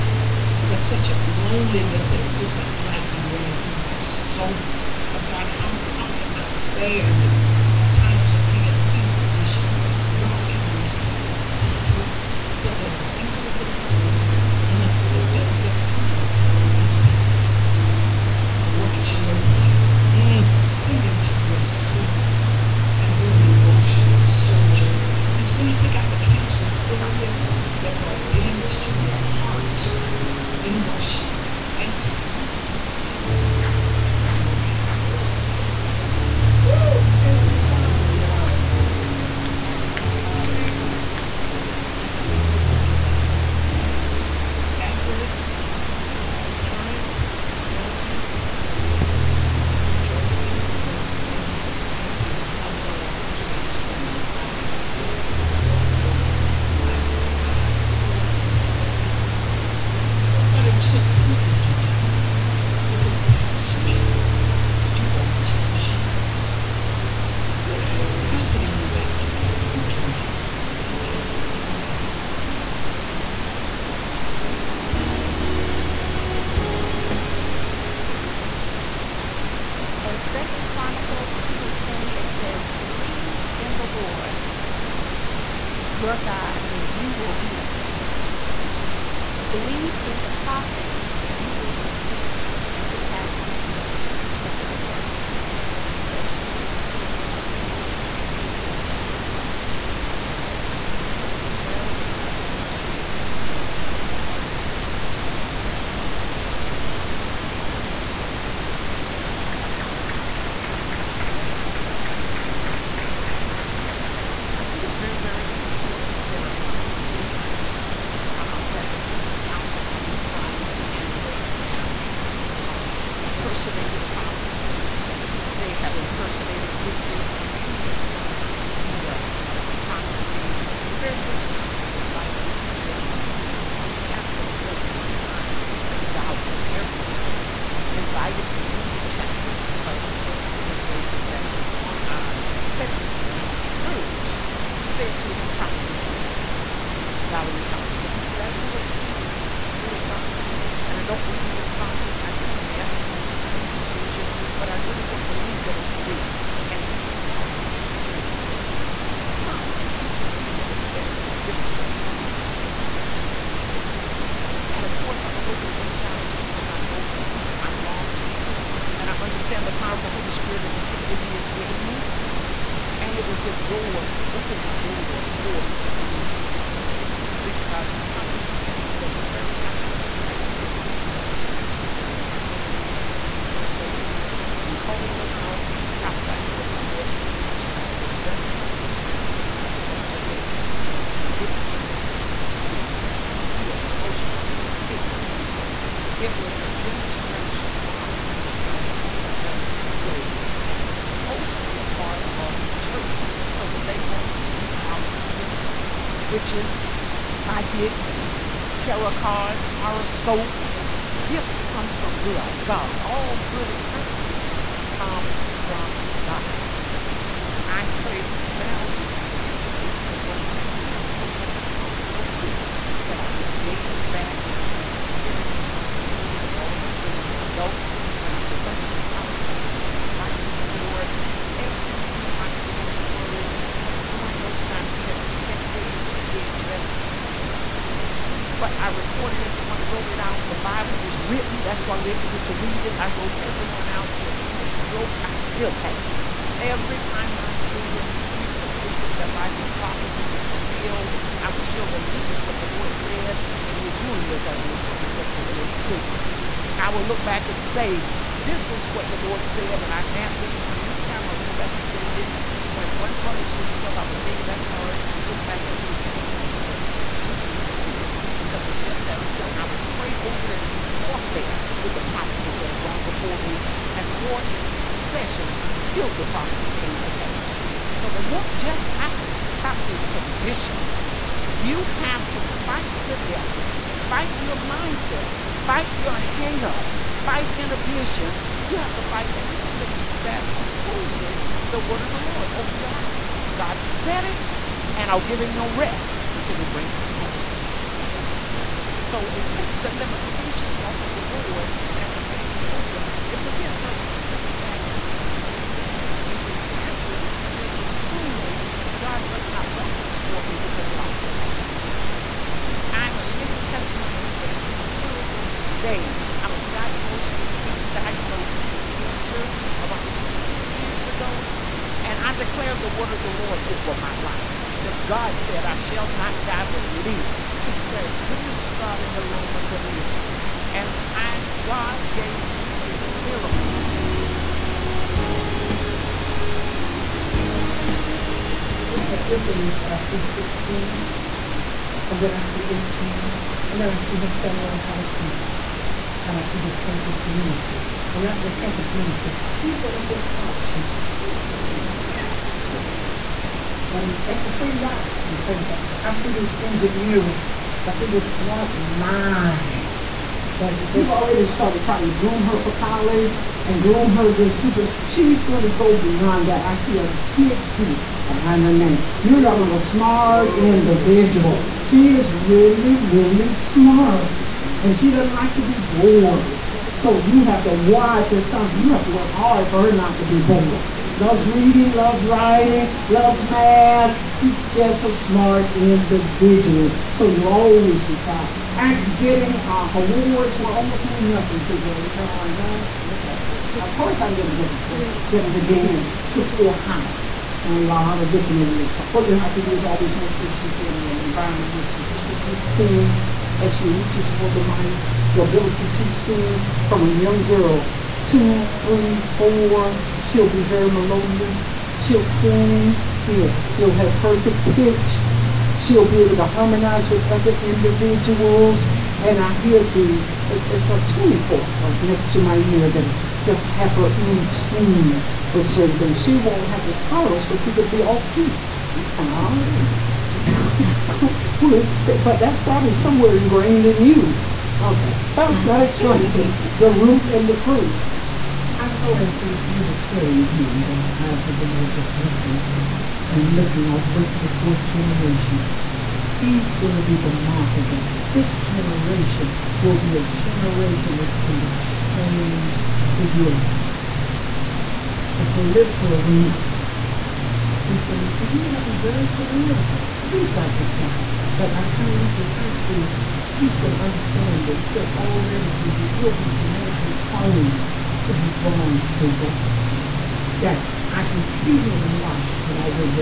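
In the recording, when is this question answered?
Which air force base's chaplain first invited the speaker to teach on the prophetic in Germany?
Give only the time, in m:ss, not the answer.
2:15.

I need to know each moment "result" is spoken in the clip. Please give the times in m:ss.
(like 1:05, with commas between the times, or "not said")
4:14.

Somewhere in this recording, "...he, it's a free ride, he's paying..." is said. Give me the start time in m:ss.
5:54.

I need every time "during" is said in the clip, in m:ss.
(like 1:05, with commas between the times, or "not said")
3:54.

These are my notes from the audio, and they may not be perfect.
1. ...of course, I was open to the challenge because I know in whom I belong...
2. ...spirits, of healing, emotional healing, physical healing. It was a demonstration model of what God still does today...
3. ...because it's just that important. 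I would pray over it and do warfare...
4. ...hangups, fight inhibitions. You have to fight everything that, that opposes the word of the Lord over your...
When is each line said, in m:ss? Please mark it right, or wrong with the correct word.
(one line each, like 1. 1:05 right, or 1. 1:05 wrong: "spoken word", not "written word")
1. 2:44 right
2. 3:12 right
3. 4:28 right
4. 4:46 right.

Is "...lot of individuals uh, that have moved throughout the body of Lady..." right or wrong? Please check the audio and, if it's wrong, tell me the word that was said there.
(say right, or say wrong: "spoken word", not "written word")
wrong: "Christ", not "Lady".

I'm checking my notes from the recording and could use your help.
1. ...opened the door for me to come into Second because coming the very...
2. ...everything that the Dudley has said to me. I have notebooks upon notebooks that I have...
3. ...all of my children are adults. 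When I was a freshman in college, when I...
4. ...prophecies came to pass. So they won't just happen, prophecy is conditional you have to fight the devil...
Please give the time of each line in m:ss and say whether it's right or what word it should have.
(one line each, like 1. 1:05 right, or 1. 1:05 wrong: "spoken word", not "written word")
1. 2:54 wrong: "Europe", not "Second"
2. 3:39 wrong: "Lord", not "Dudley"
3. 3:46 right
4. 4:36 right.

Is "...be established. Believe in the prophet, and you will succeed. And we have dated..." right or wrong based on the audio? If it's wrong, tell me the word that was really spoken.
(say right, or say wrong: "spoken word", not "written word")
wrong: "succeeded", not "dated".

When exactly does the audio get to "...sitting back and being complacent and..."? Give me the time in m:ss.
5:04.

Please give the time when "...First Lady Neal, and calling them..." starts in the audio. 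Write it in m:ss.
3:03.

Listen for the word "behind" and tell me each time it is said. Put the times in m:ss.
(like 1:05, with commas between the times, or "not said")
6:08.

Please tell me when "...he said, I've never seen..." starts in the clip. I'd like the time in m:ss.
2:28.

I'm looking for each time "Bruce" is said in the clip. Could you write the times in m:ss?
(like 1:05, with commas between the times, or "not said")
not said.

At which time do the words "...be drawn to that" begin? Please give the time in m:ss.
7:48.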